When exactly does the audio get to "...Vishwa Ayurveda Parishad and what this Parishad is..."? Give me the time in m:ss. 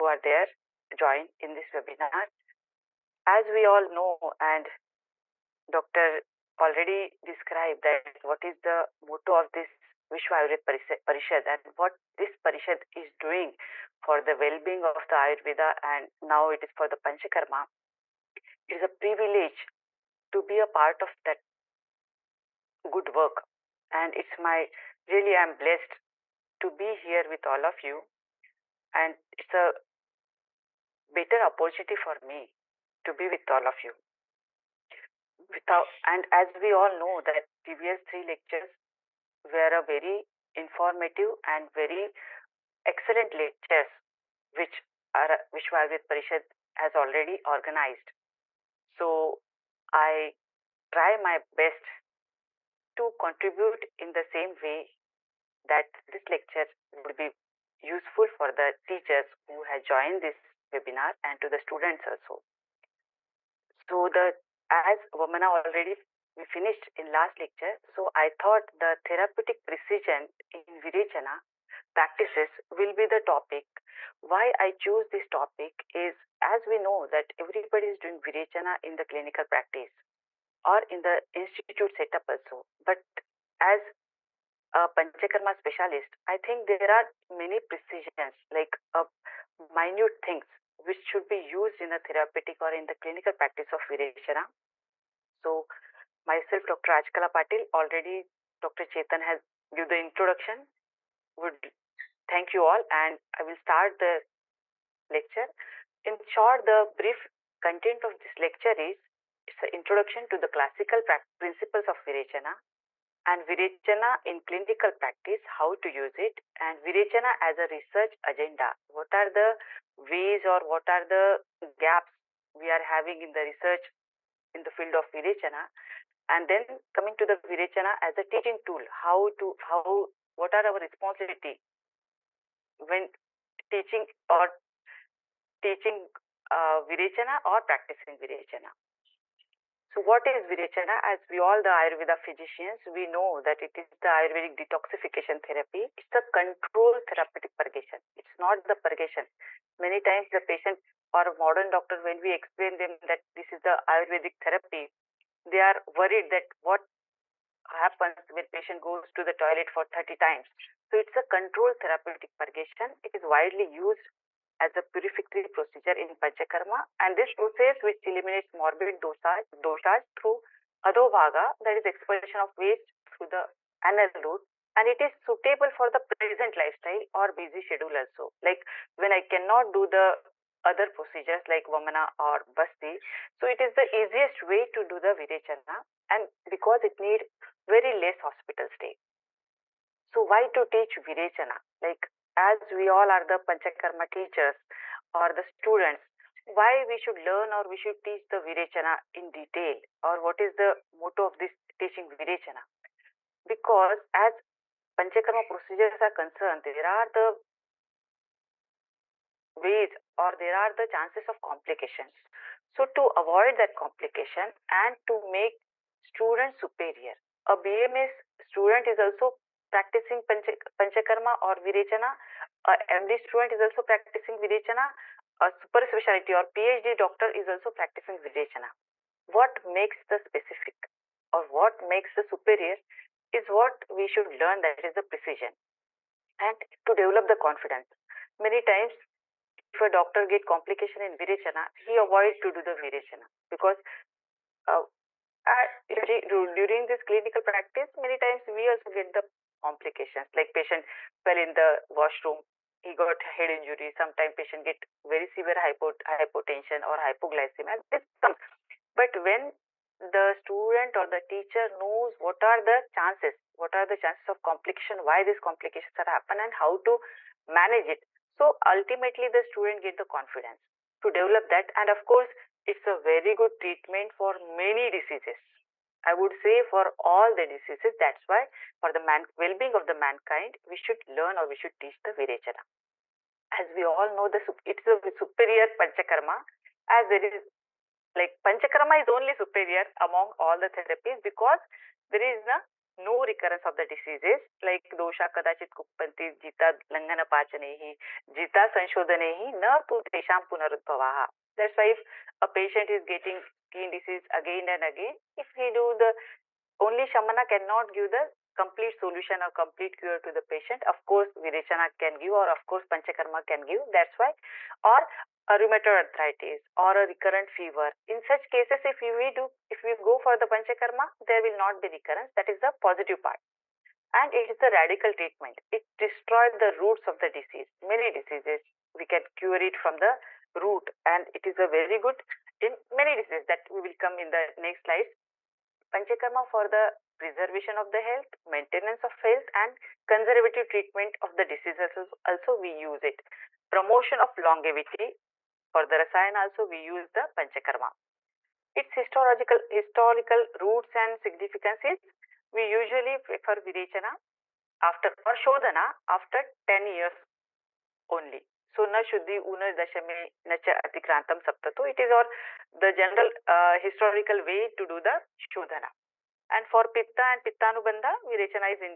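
0:10.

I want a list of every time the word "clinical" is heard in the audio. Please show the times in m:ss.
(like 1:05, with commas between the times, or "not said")
1:19, 1:32, 1:54, 4:07.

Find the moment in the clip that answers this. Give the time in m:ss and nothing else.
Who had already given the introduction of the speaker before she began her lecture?
1:38.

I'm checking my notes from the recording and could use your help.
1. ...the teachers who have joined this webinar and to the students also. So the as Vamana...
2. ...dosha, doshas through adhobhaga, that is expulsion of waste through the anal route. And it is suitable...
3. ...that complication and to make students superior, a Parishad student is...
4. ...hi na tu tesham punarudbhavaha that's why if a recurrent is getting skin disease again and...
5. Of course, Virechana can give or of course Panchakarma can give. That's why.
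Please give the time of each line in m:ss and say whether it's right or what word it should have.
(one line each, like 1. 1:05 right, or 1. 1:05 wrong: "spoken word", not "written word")
1. 0:58 right
2. 2:48 right
3. 3:33 wrong: "BMS", not "Parishad"
4. 4:58 wrong: "patient", not "recurrent"
5. 5:10 right.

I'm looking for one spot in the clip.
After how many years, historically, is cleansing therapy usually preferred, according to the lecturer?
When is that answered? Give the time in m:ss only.
5:56.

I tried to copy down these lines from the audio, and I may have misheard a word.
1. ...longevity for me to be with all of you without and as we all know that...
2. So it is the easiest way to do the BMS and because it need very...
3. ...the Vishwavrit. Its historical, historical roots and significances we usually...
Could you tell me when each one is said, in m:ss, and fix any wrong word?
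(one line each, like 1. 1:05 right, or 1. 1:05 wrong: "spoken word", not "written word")
1. 0:31 wrong: "opportunity", not "longevity"
2. 3:03 wrong: "Virechana", not "BMS"
3. 5:47 wrong: "Panchakarma", not "Vishwavrit".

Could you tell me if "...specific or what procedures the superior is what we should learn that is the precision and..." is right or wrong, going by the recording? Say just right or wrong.
wrong.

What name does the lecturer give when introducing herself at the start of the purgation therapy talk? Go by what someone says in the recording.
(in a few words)
Dr. Rajkala Patil.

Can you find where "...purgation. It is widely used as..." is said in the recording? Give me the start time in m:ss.
2:42.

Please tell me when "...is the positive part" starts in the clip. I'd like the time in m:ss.
5:22.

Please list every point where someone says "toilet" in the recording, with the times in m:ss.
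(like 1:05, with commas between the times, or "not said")
2:39.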